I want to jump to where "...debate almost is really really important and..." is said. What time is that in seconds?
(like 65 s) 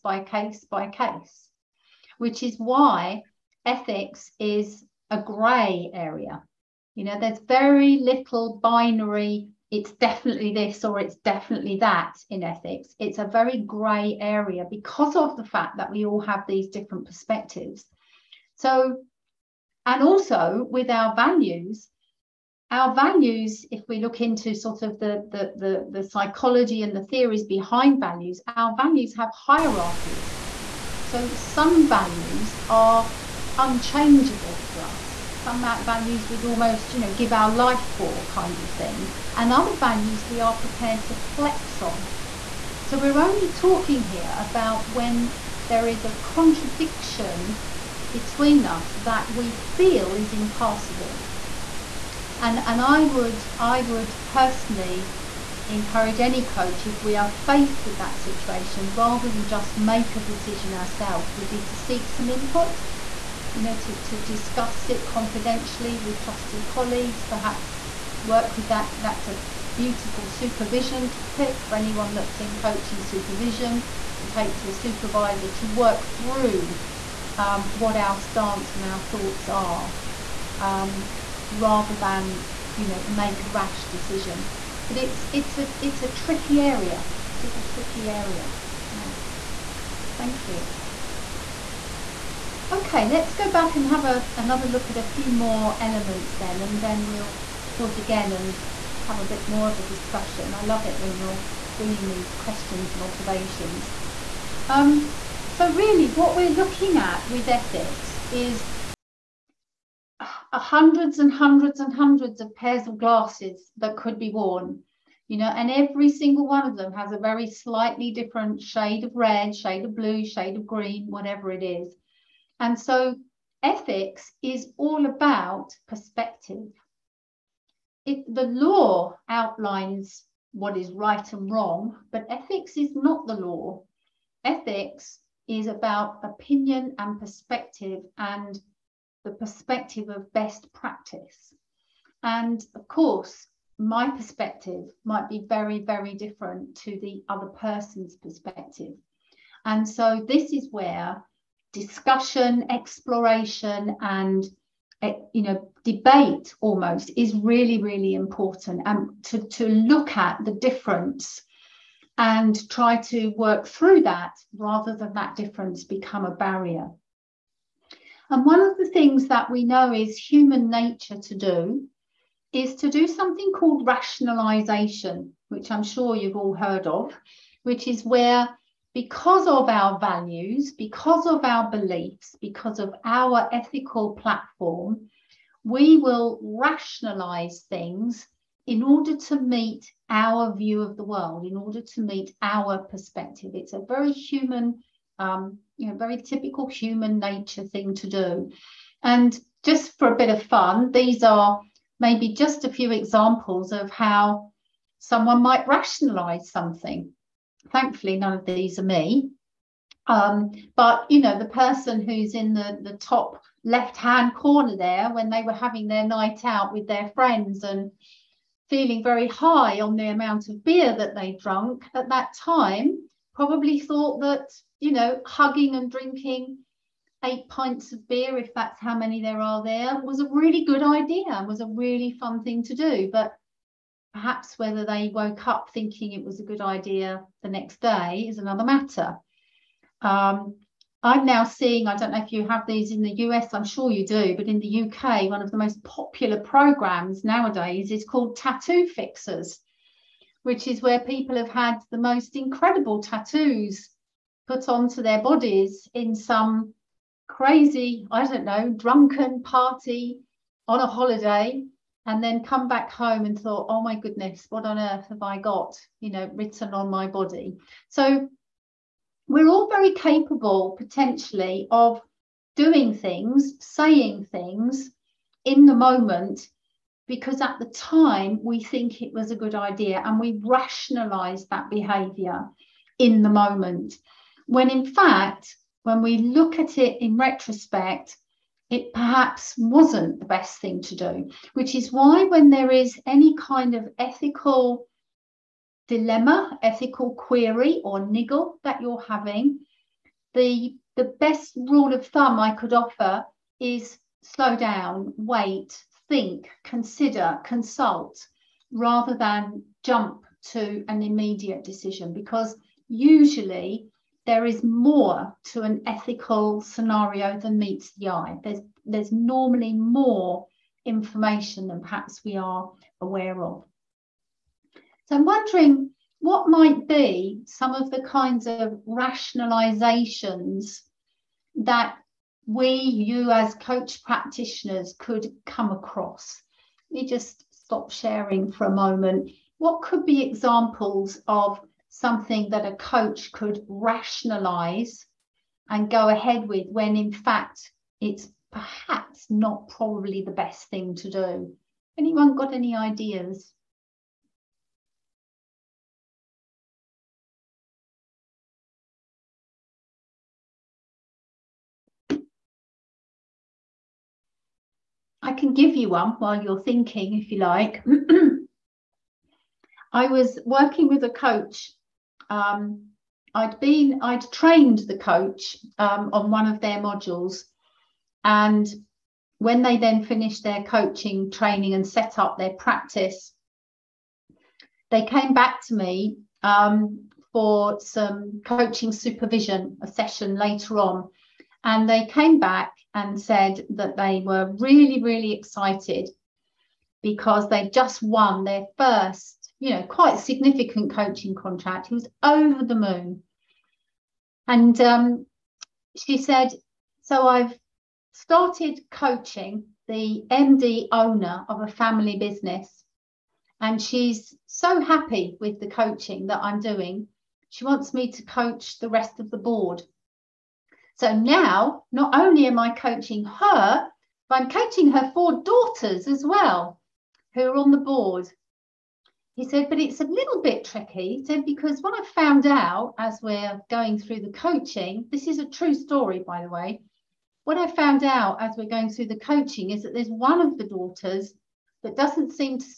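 155 s.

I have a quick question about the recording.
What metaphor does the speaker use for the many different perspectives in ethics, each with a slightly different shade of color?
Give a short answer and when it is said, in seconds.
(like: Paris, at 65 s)
Pairs of glasses, at 112 s.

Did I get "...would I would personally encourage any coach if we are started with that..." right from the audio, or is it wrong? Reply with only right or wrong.
wrong.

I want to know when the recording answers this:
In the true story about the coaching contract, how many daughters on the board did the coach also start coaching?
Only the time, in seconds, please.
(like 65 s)
425 s.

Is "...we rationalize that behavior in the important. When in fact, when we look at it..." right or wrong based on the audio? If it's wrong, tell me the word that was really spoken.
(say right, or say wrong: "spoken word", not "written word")
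wrong: "moment", not "important".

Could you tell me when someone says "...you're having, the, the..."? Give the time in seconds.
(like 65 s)
298 s.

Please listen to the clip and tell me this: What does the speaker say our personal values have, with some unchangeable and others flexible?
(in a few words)
Hierarchies.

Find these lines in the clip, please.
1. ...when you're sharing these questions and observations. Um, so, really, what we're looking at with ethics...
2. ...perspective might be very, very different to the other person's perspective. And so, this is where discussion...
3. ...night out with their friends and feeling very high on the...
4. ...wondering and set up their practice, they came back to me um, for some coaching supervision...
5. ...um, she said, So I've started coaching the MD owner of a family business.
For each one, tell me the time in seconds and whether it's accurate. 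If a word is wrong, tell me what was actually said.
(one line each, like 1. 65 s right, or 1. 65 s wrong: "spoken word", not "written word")
1. 100 s wrong: "bringing", not "sharing"
2. 144 s right
3. 216 s right
4. 381 s wrong: "training", not "wondering"
5. 404 s right.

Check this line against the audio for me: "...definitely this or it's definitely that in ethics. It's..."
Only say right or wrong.
right.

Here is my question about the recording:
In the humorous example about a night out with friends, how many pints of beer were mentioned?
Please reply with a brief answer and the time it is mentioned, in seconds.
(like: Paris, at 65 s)
8, at 227 s.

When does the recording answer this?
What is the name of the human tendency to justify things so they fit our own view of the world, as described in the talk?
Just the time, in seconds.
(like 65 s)
173 s.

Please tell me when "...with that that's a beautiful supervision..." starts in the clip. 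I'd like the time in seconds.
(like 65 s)
68 s.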